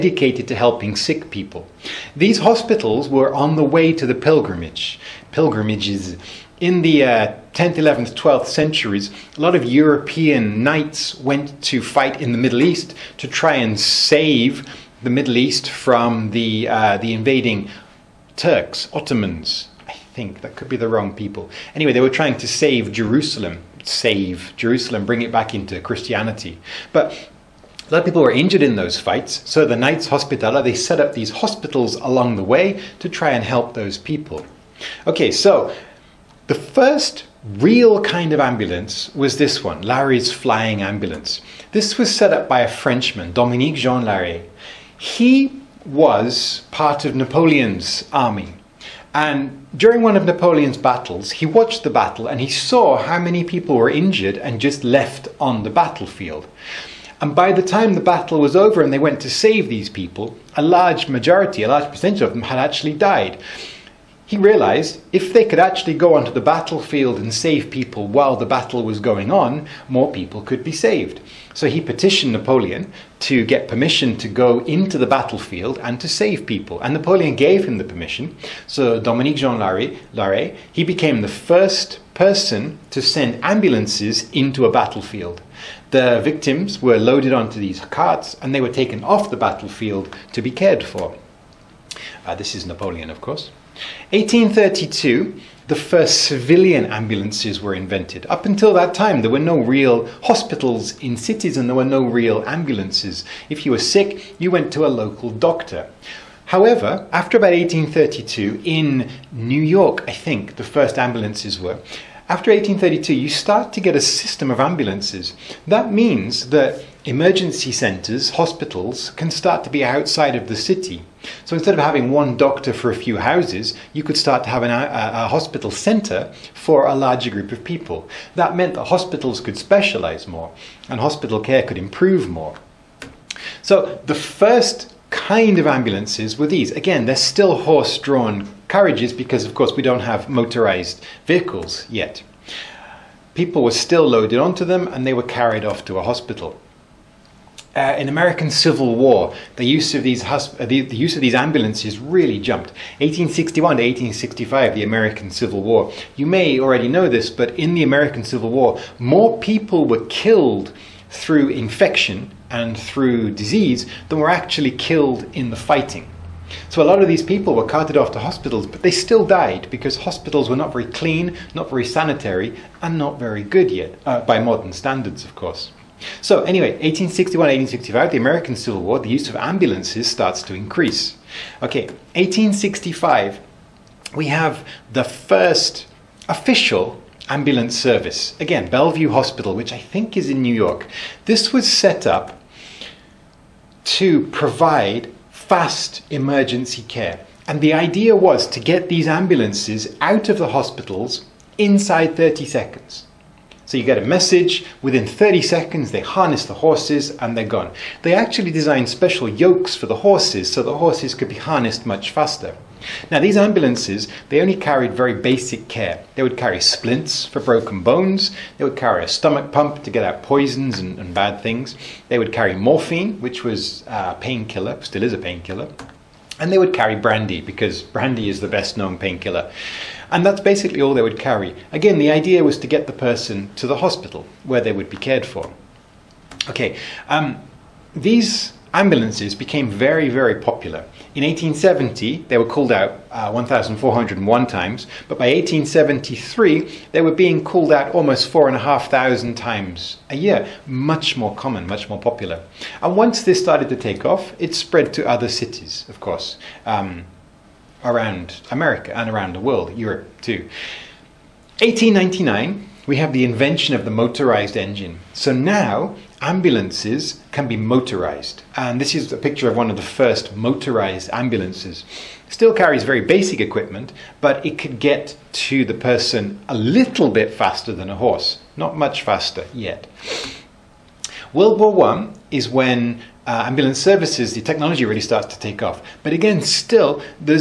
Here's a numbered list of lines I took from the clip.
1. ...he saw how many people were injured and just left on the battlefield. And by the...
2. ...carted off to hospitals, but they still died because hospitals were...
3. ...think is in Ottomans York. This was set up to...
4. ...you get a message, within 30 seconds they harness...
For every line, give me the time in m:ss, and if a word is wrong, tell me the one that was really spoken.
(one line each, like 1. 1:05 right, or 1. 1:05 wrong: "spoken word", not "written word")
1. 0:52 right
2. 2:47 right
3. 3:09 wrong: "New", not "Ottomans"
4. 3:23 right.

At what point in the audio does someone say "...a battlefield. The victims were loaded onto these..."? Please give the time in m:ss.
1:24.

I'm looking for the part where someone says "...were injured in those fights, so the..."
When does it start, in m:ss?
0:28.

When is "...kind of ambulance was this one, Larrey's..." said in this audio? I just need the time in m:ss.
0:38.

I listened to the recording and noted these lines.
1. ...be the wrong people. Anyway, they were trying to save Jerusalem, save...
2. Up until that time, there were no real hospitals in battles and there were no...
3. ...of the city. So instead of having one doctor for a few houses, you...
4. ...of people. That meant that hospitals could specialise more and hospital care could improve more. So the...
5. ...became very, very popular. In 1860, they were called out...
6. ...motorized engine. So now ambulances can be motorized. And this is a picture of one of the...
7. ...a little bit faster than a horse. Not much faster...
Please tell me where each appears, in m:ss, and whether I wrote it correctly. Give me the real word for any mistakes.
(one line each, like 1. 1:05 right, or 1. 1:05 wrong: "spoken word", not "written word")
1. 0:20 right
2. 1:38 wrong: "cities", not "battles"
3. 2:00 right
4. 2:07 right
5. 3:59 wrong: "1870", not "1860"
6. 4:23 right
7. 4:36 right.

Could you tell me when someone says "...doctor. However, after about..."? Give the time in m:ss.
1:45.